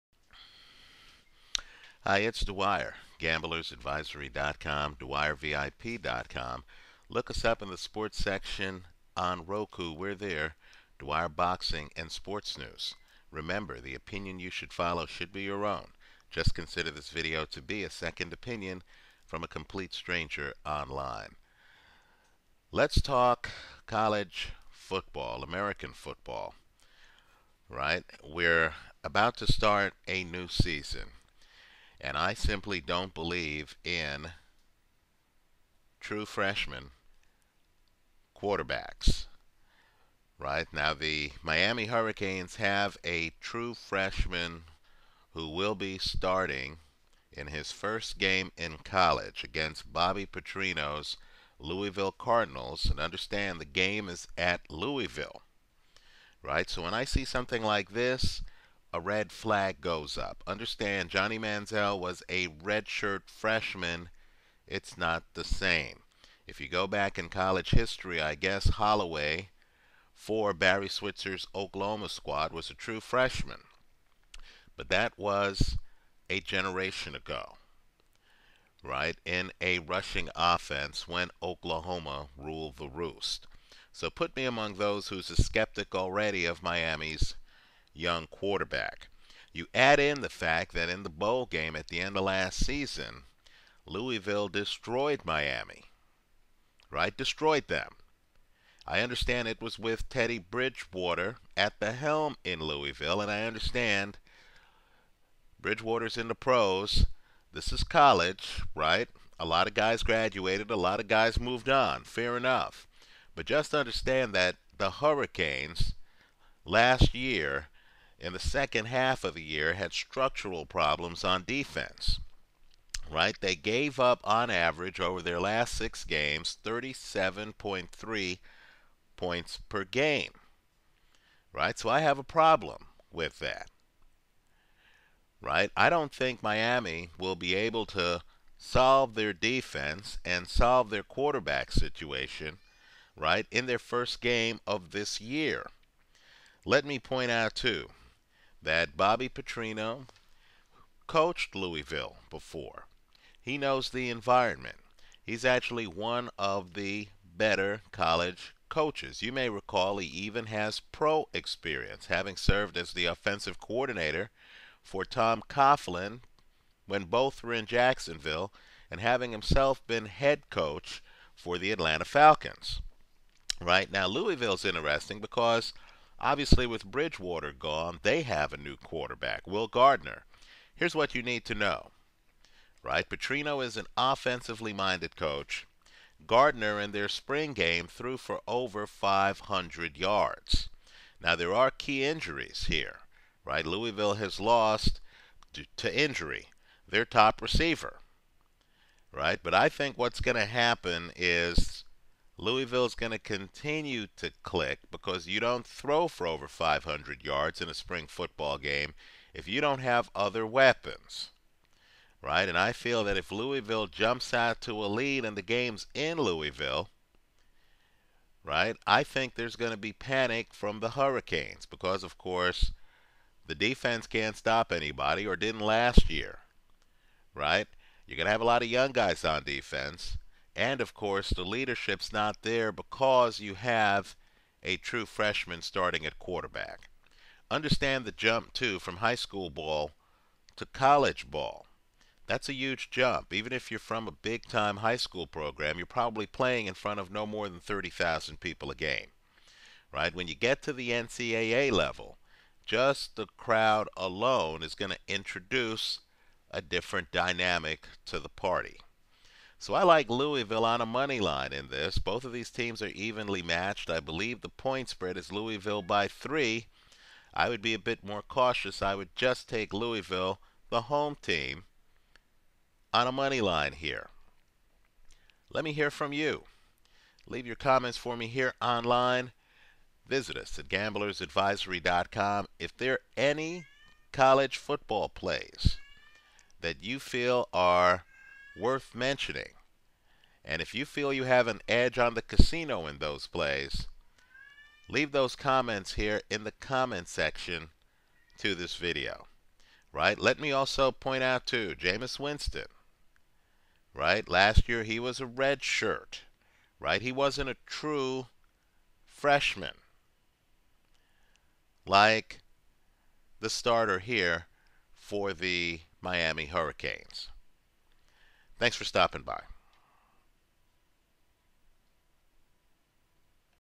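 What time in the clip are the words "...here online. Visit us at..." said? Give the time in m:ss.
4:38.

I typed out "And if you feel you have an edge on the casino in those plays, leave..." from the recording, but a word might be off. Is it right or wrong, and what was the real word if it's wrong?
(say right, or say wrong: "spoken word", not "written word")
right.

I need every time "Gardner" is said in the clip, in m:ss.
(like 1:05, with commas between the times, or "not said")
2:59, 3:06.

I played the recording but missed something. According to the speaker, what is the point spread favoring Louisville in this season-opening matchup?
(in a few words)
3.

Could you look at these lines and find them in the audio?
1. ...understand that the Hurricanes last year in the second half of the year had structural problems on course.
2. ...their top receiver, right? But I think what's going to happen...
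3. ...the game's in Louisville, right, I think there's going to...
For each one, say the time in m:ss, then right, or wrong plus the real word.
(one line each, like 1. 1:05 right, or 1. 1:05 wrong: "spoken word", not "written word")
1. 1:53 wrong: "defense", not "course"
2. 3:16 right
3. 3:35 right.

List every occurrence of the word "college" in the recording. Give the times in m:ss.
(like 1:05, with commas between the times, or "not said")
0:23, 0:48, 1:07, 1:47, 2:37, 4:00, 4:44.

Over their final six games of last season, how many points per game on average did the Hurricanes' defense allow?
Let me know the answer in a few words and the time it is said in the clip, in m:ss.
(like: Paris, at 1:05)
37.3, at 2:06.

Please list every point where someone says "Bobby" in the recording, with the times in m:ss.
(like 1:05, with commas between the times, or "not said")
0:49, 2:28.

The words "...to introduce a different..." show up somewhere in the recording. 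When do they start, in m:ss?
4:14.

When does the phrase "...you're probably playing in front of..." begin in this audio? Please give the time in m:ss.
4:05.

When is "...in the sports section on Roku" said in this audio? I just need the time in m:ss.
0:07.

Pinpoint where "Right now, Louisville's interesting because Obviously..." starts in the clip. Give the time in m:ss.
2:53.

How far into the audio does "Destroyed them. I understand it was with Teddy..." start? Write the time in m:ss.
1:37.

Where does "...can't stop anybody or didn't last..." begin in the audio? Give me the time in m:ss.
3:44.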